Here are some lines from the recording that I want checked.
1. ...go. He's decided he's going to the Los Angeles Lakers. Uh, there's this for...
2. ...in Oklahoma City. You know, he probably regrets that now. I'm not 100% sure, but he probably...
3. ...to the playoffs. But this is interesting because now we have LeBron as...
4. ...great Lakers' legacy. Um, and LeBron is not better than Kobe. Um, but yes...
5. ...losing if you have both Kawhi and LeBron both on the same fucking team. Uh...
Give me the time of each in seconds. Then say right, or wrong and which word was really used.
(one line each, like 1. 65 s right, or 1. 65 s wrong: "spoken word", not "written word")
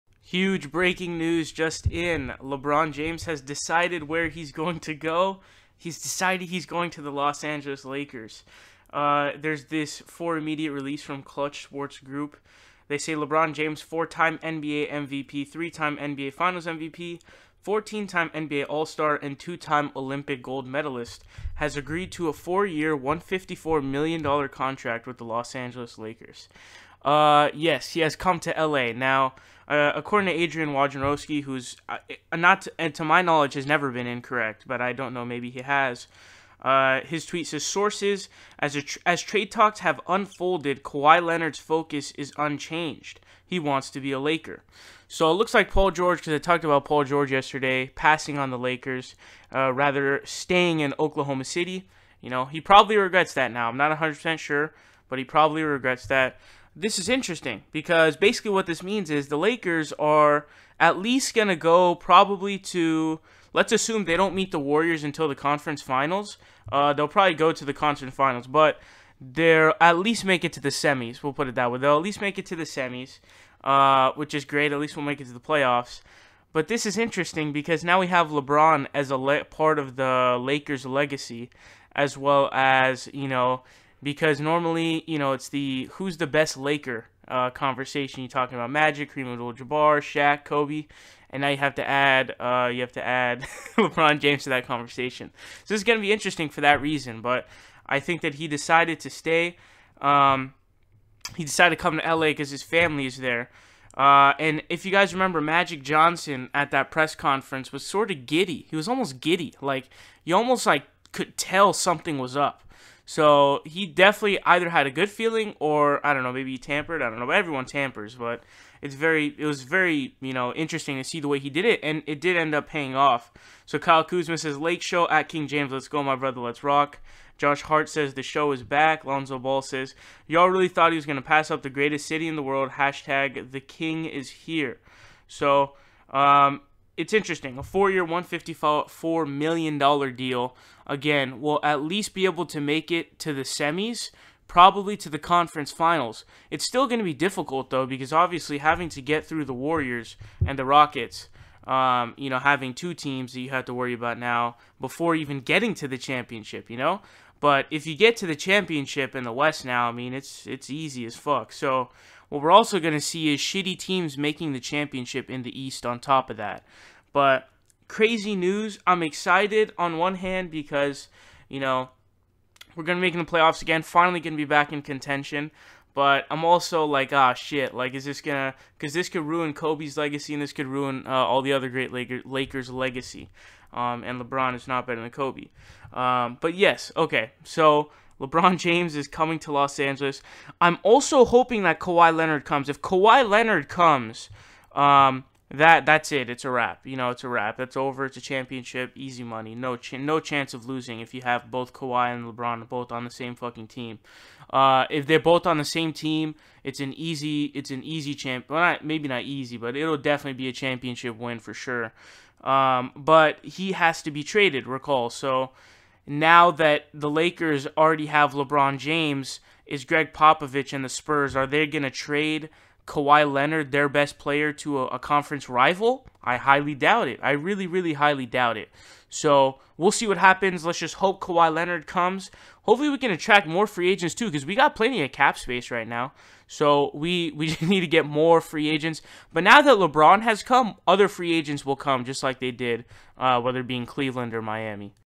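1. 4 s right
2. 50 s right
3. 75 s right
4. 181 s right
5. 200 s right.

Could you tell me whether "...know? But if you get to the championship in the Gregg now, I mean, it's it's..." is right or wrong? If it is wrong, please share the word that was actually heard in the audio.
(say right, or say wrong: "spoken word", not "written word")
wrong: "West", not "Gregg".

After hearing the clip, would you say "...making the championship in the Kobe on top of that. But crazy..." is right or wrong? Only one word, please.
wrong.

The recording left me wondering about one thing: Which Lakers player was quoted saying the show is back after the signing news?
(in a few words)
Josh Hart.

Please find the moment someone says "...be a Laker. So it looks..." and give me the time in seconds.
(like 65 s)
44 s.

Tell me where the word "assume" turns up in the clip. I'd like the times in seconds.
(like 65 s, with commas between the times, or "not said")
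63 s.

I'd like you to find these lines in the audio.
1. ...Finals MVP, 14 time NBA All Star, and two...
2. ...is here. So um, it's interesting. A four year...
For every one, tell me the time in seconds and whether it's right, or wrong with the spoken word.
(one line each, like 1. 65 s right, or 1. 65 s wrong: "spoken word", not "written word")
1. 16 s right
2. 134 s right.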